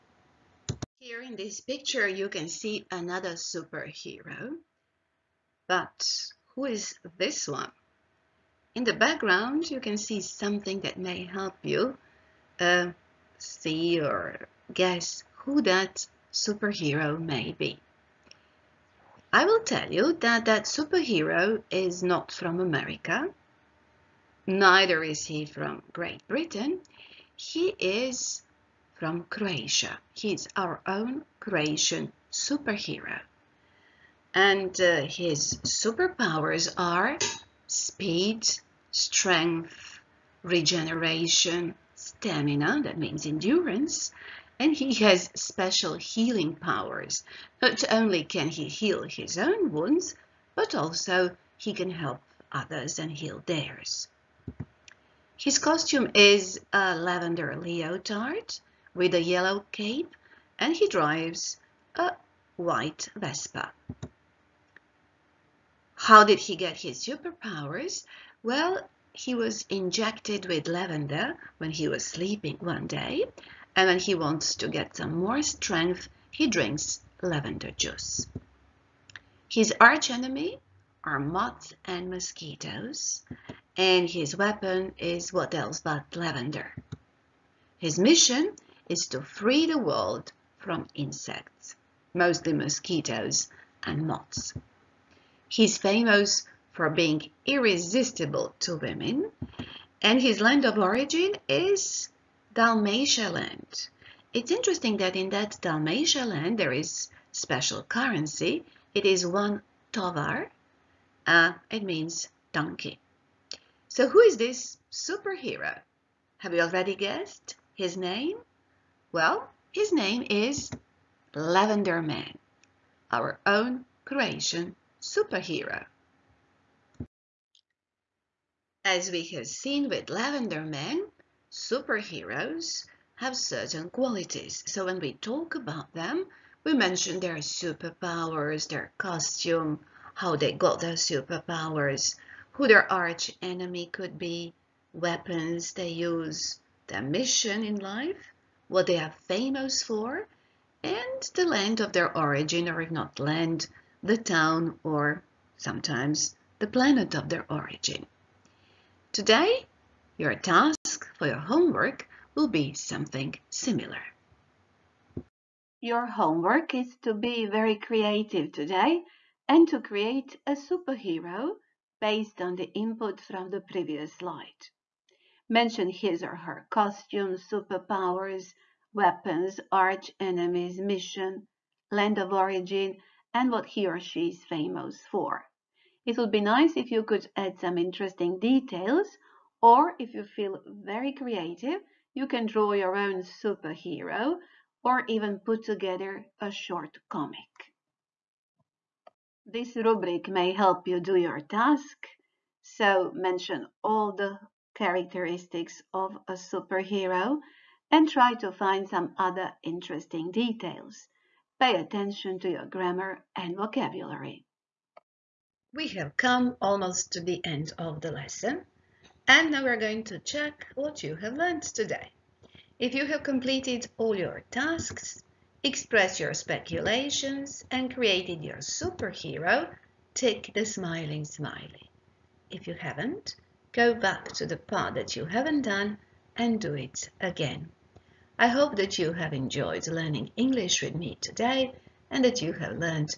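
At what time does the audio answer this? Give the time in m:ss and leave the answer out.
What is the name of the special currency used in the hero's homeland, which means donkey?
1:49.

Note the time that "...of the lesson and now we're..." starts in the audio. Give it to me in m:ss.
3:37.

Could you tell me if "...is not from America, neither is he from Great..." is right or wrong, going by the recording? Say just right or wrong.
right.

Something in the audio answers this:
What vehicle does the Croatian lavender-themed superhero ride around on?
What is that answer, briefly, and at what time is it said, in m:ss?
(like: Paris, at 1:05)
White Vespa, at 1:02.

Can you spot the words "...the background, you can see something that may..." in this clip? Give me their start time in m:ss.
0:08.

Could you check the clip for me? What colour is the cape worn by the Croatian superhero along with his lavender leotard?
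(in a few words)
Yellow.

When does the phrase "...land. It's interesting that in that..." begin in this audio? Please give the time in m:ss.
1:43.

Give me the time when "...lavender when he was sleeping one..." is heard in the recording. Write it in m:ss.
1:10.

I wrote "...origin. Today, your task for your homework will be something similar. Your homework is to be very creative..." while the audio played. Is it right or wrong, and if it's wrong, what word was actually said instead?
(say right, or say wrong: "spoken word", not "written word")
right.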